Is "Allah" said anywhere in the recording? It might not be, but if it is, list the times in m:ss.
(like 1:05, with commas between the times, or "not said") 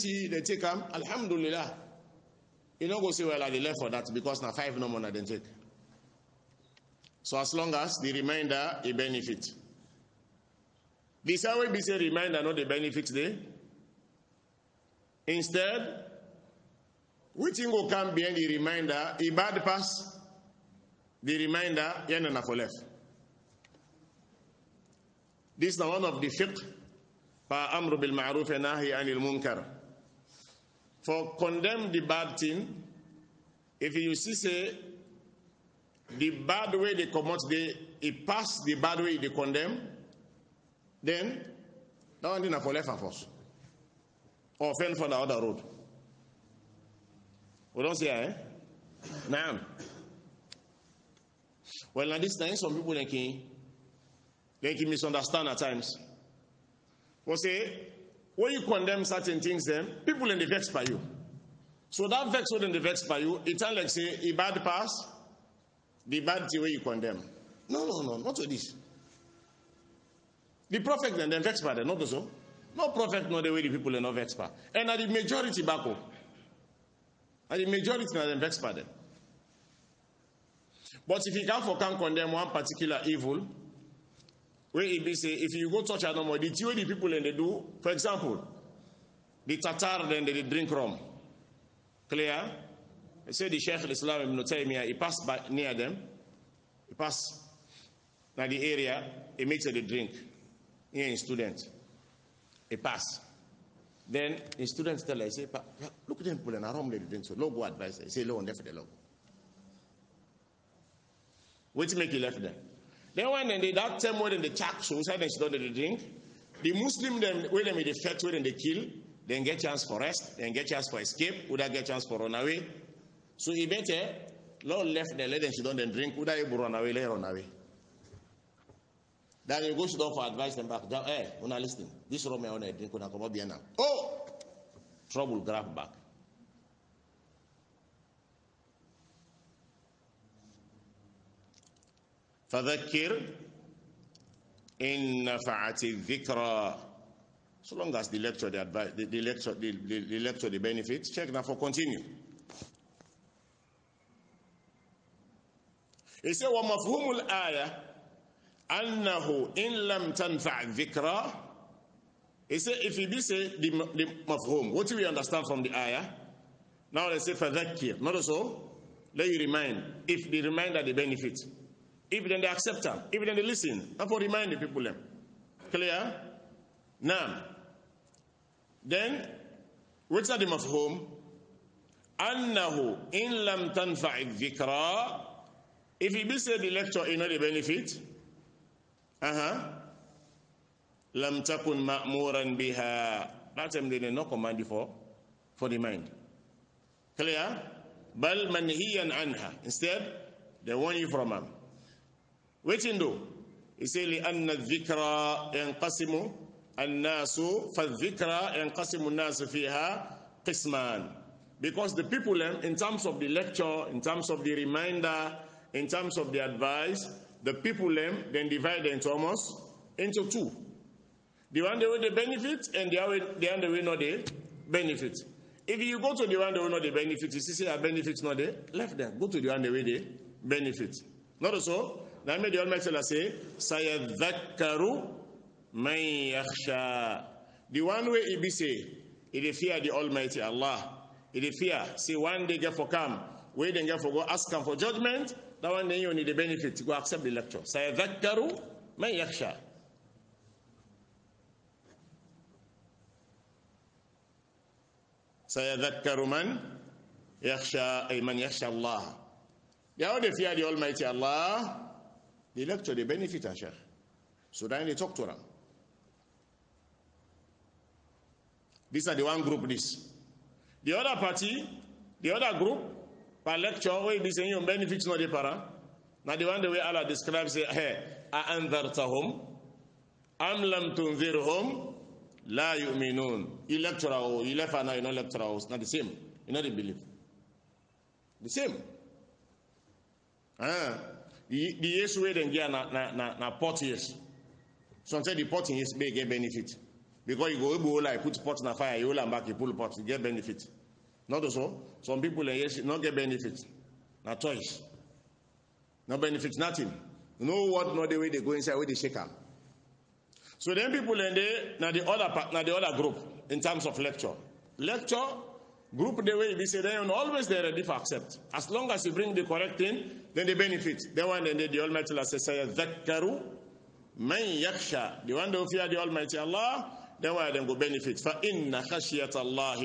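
4:00, 4:36, 5:22, 5:26.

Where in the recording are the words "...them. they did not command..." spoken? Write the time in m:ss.
3:13.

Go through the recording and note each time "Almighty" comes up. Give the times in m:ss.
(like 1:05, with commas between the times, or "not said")
3:52, 3:59, 5:21, 5:25.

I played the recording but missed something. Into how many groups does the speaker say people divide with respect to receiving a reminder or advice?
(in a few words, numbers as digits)
2.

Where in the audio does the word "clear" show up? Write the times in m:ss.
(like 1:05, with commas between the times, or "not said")
1:32, 2:55, 3:17.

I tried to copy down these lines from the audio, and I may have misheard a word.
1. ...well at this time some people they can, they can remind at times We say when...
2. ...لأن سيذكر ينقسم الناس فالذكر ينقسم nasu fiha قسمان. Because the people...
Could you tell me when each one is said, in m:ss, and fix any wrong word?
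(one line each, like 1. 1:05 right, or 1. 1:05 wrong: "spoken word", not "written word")
1. 0:51 wrong: "misunderstand", not "remind"
2. 3:24 wrong: "الذكر", not "سيذكر".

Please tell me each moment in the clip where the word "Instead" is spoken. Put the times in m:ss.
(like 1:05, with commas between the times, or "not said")
0:15, 3:19.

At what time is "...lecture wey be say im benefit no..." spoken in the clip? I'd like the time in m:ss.
4:33.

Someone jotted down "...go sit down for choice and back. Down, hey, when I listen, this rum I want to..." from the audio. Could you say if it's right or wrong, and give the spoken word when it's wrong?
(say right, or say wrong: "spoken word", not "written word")
wrong: "advice", not "choice".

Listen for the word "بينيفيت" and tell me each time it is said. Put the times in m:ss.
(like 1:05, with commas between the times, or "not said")
4:06, 4:23.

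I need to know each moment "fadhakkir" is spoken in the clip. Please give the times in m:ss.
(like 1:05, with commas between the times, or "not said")
2:47.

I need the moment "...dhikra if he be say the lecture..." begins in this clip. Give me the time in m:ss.
3:04.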